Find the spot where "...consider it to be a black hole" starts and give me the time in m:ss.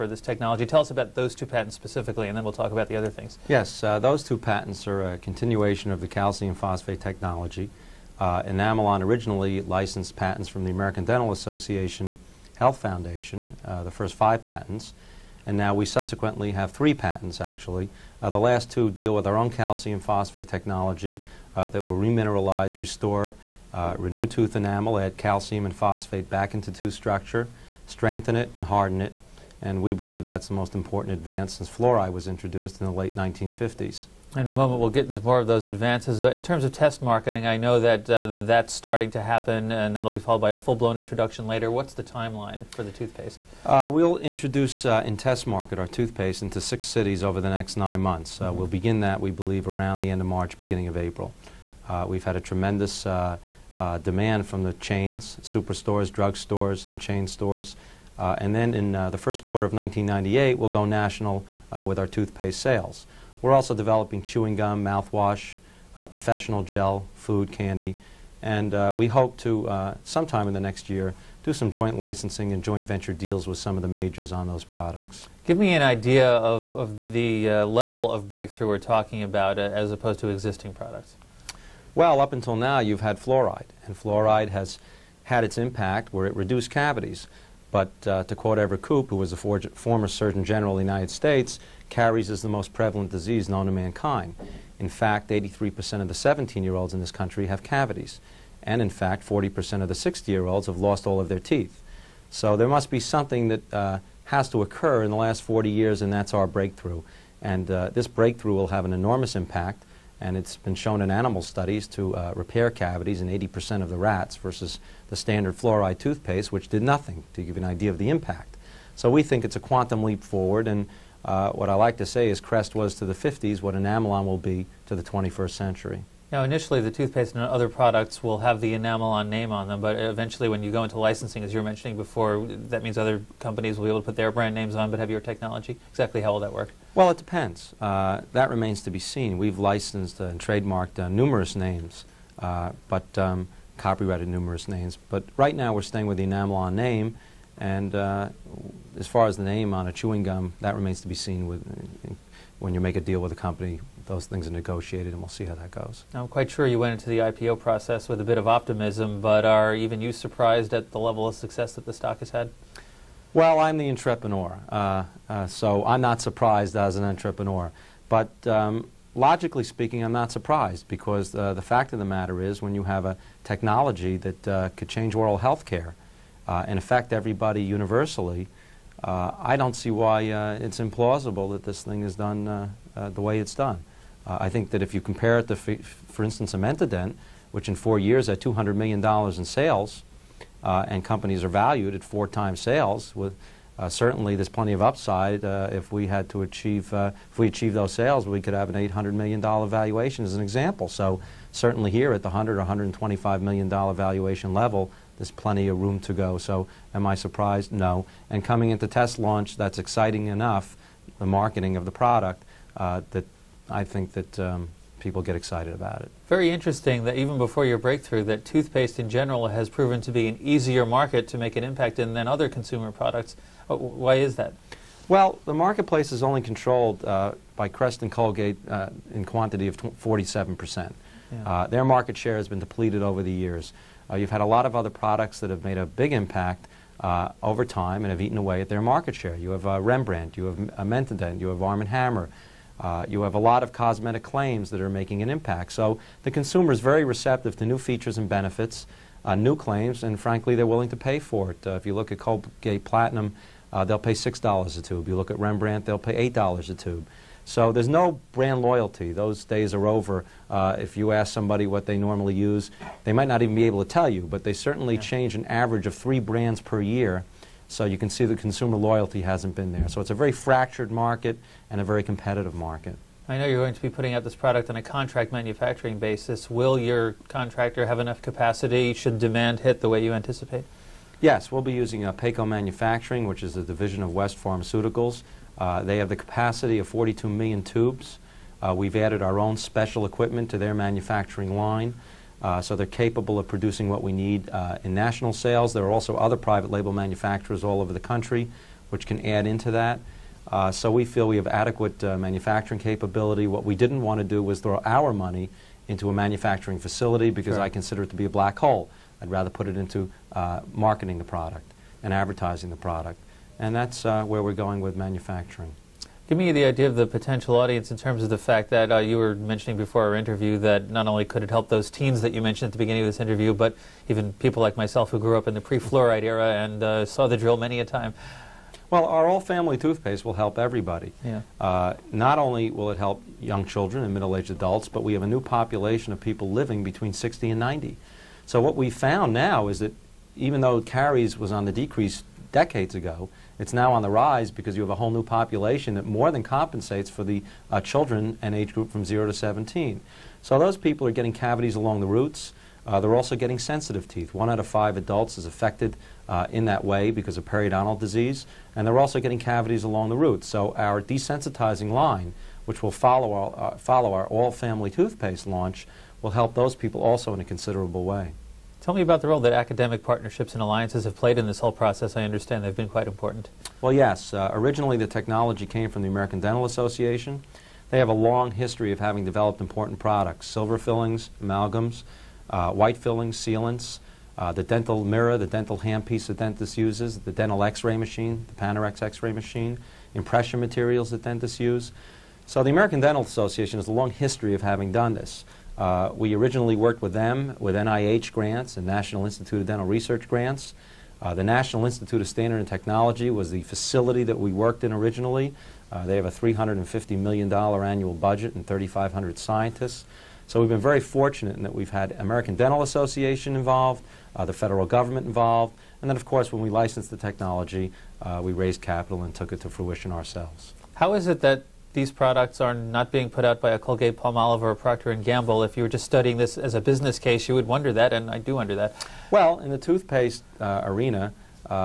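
5:07.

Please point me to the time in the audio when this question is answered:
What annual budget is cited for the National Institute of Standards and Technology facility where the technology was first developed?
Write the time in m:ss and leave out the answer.
6:46.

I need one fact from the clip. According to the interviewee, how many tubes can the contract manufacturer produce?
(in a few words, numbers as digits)
42 million.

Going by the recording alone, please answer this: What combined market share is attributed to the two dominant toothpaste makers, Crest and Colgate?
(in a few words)
47%.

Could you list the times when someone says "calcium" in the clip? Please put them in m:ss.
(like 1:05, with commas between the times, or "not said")
0:06, 0:19, 0:25.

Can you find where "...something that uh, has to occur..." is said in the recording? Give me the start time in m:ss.
1:42.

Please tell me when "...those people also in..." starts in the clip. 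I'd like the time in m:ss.
6:06.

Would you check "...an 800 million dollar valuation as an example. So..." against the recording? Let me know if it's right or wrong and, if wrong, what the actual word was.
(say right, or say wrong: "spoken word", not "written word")
right.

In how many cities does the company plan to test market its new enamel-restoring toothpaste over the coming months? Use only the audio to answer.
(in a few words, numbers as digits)
6.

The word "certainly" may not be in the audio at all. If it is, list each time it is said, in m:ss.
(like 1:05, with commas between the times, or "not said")
3:13, 3:21, 4:24.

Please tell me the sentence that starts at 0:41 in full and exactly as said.
What's the timeline for the toothpaste?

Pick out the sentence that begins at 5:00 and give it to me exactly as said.
Uh, so we feel we have adequate uh, manufacturing capability.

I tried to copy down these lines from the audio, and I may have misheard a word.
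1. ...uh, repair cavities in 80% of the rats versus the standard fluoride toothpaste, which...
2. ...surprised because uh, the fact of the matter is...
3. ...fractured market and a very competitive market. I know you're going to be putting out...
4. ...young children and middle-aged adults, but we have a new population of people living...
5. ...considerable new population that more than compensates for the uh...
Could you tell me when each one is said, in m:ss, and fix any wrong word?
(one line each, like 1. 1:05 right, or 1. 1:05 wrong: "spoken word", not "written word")
1. 1:52 right
2. 2:50 right
3. 4:30 right
4. 5:33 right
5. 5:44 wrong: "whole", not "considerable".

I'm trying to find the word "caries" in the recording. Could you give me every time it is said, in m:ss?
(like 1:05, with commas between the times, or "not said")
1:31, 5:40.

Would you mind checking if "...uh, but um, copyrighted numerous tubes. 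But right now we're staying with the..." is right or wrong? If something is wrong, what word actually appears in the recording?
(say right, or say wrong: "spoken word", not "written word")
wrong: "names", not "tubes".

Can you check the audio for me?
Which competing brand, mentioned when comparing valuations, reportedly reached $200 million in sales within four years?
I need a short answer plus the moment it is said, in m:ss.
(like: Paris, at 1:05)
Dent, at 3:06.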